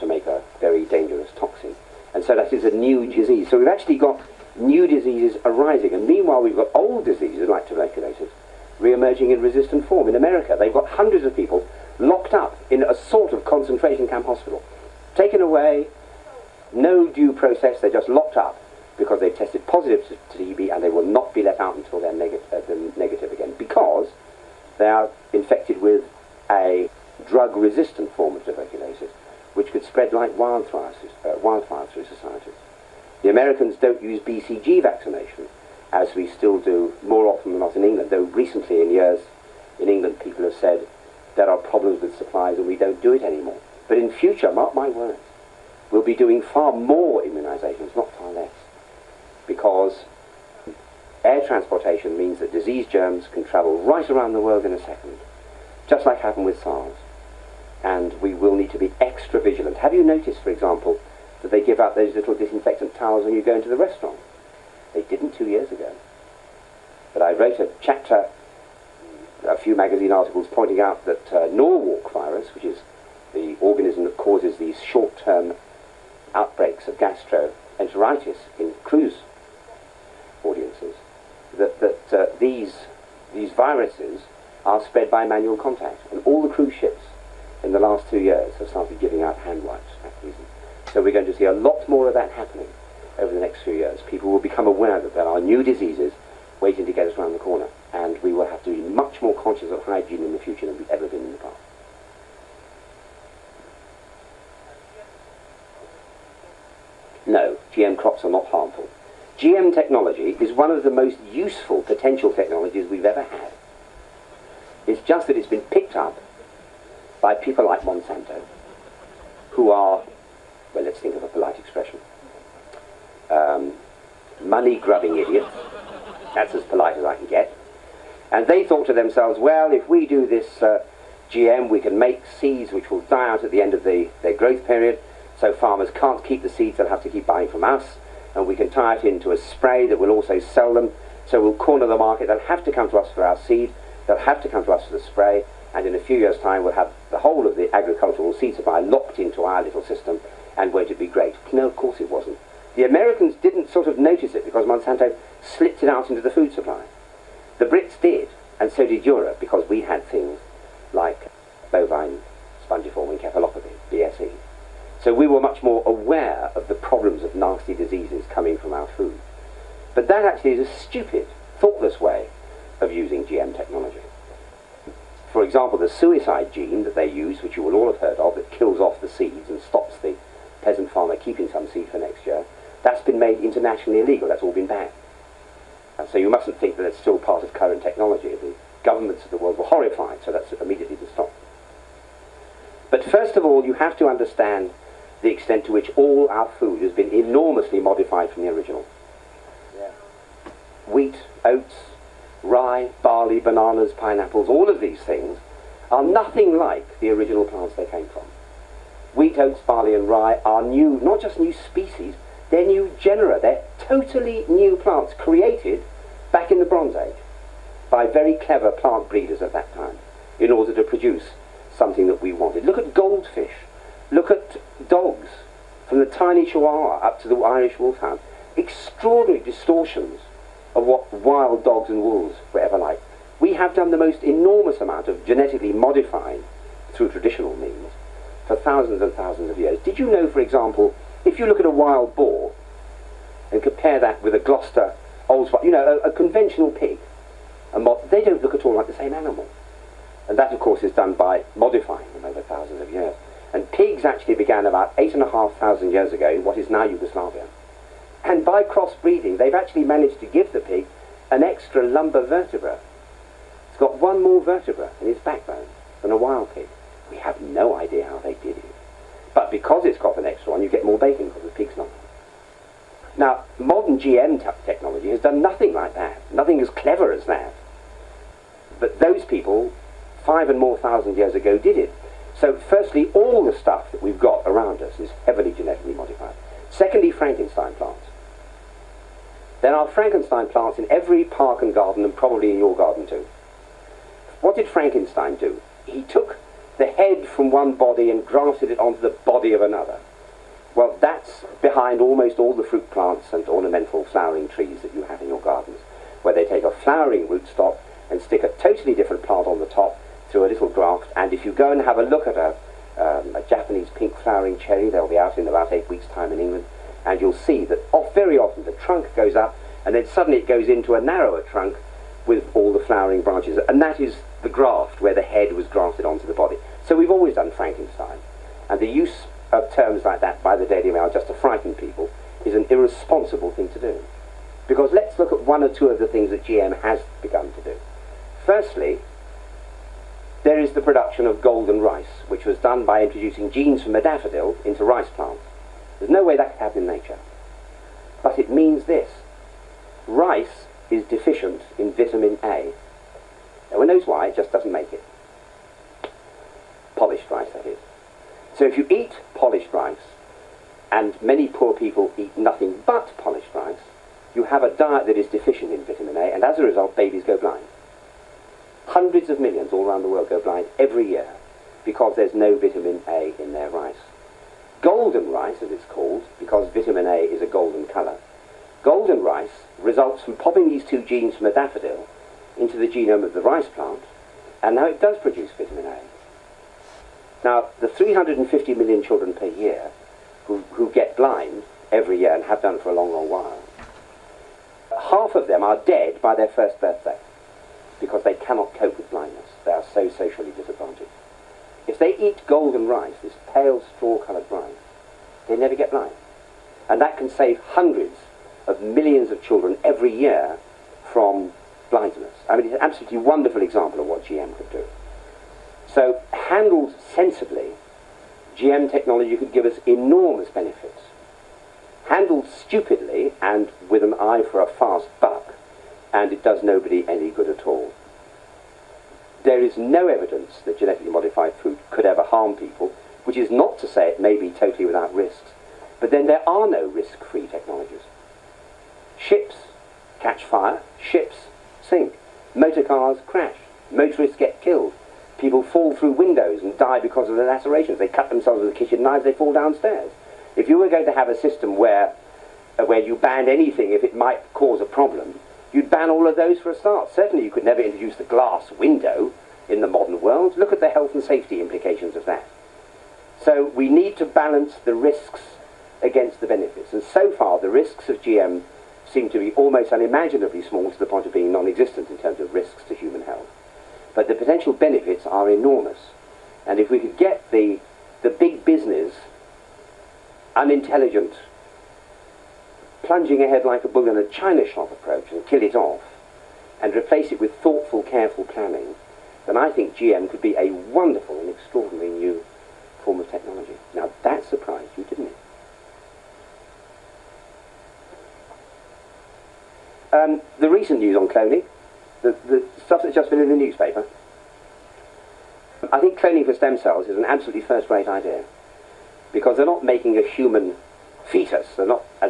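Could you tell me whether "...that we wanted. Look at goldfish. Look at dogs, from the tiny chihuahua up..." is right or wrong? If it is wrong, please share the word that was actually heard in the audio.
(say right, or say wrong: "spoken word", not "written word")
right.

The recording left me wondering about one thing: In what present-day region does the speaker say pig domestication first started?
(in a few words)
Yugoslavia.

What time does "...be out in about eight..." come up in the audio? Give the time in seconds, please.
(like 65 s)
315 s.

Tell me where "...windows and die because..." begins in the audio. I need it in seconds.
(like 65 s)
446 s.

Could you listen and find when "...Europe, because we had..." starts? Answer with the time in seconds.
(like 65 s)
159 s.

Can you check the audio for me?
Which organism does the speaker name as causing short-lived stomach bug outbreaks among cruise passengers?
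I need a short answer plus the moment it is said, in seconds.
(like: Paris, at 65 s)
Norwalk virus, at 71 s.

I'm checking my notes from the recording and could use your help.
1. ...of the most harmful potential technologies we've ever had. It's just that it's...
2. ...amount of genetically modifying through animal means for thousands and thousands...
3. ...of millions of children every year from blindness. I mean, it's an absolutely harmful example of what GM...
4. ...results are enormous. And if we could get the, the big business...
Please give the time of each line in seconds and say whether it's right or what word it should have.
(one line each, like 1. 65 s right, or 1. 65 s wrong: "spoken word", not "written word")
1. 110 s wrong: "useful", not "harmful"
2. 234 s wrong: "traditional", not "animal"
3. 408 s wrong: "wonderful", not "harmful"
4. 474 s wrong: "benefits", not "results".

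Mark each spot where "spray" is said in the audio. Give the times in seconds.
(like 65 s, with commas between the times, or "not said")
139 s, 145 s.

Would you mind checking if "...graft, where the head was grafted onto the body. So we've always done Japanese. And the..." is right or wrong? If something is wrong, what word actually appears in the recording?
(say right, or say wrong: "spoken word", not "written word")
wrong: "Frankenstein", not "Japanese".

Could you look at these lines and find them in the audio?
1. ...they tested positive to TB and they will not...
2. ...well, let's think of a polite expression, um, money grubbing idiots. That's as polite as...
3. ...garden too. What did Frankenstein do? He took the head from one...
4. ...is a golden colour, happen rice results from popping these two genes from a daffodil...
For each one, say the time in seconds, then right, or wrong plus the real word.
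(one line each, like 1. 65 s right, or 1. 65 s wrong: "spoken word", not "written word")
1. 19 s right
2. 120 s right
3. 292 s right
4. 377 s wrong: "golden", not "happen".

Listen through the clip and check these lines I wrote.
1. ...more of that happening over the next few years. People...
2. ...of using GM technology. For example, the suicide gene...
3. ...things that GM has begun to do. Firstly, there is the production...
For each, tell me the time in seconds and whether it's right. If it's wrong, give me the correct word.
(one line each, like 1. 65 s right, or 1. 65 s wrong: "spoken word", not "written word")
1. 91 s right
2. 172 s right
3. 336 s right.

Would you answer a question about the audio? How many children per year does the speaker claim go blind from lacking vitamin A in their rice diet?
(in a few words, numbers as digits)
350 million.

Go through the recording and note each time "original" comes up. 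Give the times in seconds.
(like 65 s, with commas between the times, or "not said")
198 s, 207 s.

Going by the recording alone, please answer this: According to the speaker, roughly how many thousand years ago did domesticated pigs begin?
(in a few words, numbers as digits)
8.5 thousand years.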